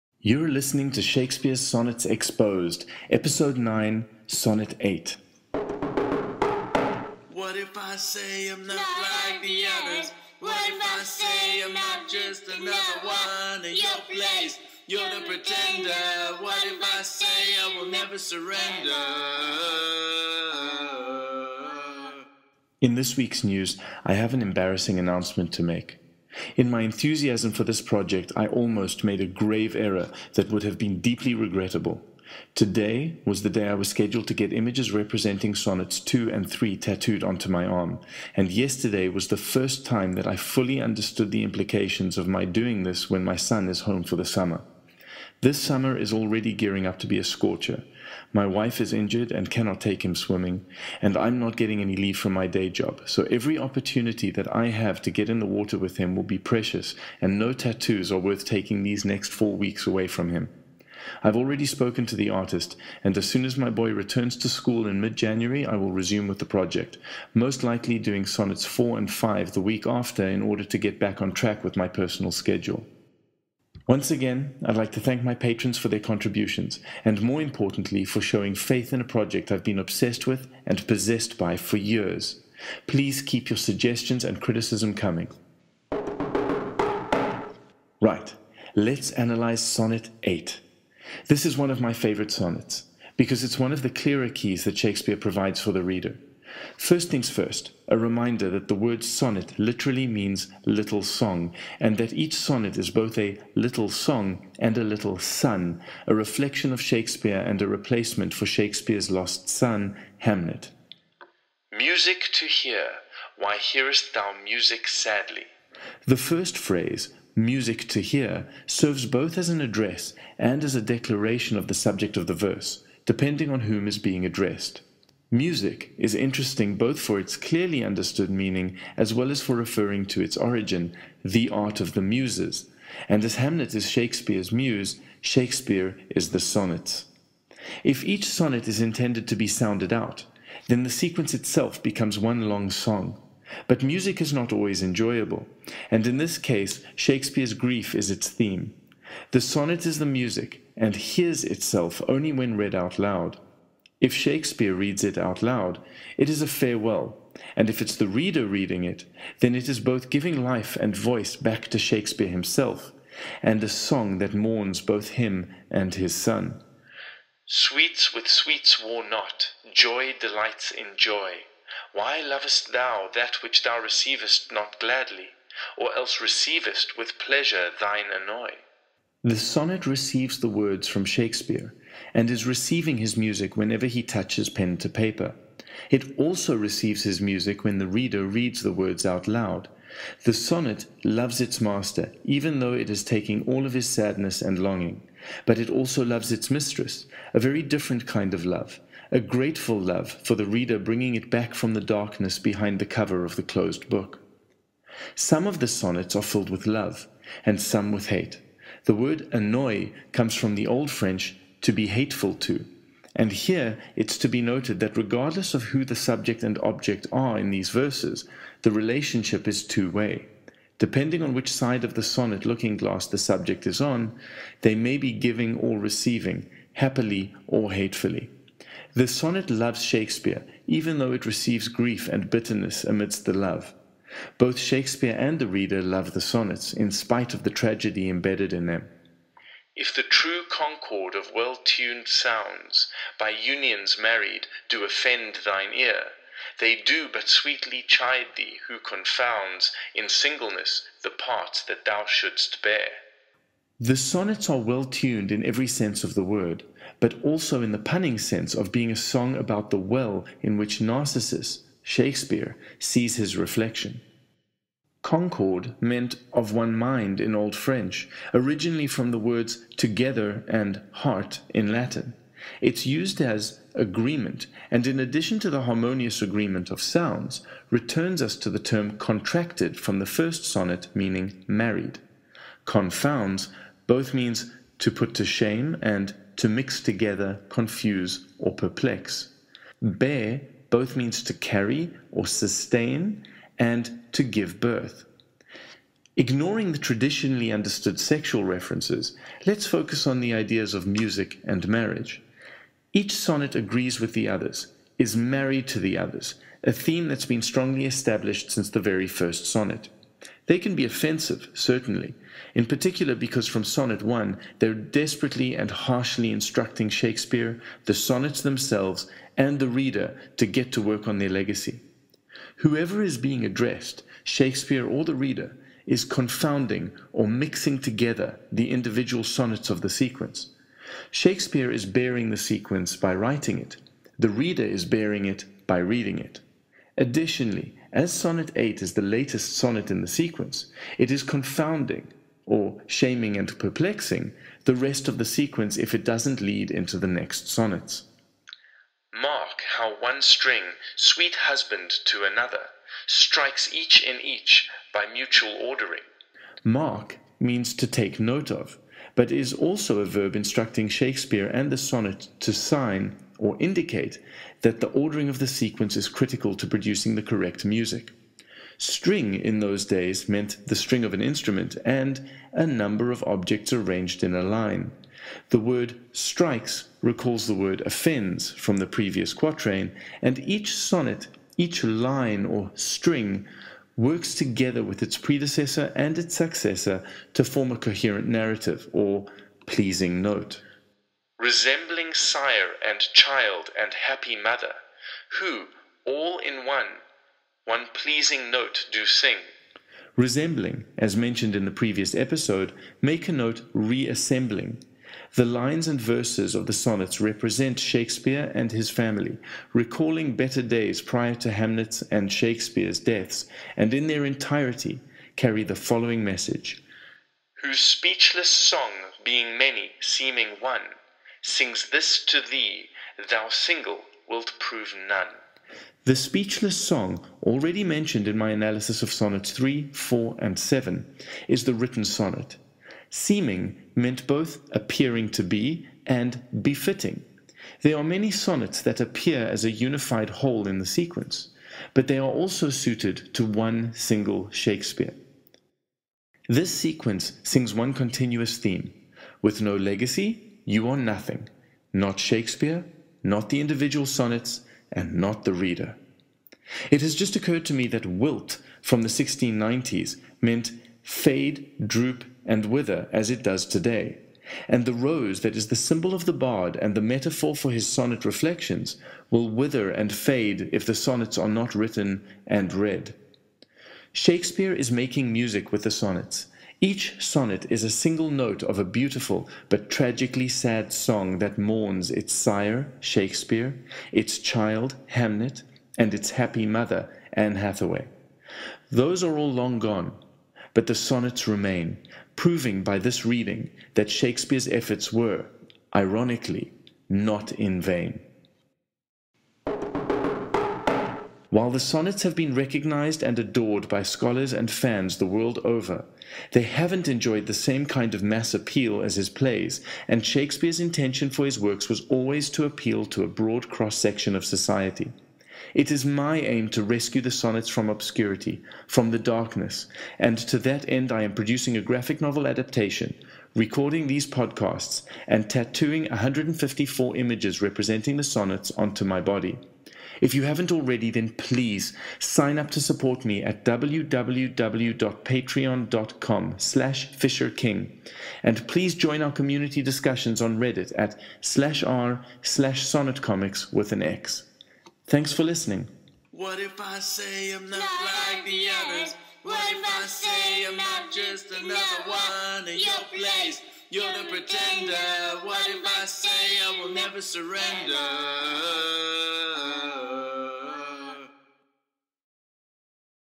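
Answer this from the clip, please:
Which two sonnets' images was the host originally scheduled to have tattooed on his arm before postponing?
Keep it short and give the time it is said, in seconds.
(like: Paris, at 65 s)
2 and 3, at 35 s.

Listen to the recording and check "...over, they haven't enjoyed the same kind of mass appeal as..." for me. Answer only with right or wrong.
right.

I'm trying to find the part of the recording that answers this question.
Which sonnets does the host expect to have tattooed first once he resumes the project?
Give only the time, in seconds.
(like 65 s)
68 s.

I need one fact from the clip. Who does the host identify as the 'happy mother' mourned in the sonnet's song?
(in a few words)
Anne Hathaway.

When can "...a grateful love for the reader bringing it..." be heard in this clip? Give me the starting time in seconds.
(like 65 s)
199 s.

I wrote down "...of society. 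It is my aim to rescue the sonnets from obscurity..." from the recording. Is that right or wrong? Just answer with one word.
right.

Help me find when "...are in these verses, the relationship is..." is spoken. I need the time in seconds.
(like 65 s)
217 s.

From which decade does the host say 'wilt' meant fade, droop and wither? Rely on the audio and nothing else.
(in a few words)
1690s.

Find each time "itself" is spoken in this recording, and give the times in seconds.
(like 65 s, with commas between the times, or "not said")
141 s, 151 s.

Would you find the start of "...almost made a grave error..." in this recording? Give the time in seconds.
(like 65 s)
28 s.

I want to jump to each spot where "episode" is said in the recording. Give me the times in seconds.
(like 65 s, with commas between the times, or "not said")
3 s, 402 s.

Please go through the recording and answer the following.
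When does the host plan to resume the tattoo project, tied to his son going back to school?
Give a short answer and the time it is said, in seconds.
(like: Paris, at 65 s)
mid January, at 65 s.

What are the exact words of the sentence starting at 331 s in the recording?
Shakespeare is bearing the sequence by writing it.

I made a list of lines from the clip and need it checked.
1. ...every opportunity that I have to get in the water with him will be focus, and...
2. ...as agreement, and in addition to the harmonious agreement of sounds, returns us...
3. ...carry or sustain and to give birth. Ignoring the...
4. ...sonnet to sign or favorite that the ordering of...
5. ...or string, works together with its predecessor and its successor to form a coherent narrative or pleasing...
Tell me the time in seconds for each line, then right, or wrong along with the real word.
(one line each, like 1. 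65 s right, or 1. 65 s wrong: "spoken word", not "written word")
1. 53 s wrong: "precious", not "focus"
2. 273 s right
3. 291 s right
4. 361 s wrong: "indicate", not "favorite"
5. 382 s right.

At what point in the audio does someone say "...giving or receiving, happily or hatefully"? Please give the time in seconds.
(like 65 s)
225 s.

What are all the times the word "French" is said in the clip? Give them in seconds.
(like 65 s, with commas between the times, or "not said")
210 s, 267 s.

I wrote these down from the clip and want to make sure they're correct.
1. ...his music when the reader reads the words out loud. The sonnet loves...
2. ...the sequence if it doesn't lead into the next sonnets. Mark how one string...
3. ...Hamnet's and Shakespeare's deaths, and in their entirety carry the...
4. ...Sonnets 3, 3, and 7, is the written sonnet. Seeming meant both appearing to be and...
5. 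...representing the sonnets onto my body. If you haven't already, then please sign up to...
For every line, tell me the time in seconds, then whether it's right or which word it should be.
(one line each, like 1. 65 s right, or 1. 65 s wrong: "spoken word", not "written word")
1. 187 s right
2. 345 s right
3. 411 s right
4. 429 s wrong: "4", not "3"
5. 527 s right.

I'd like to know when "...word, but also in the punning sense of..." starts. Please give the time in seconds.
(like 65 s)
256 s.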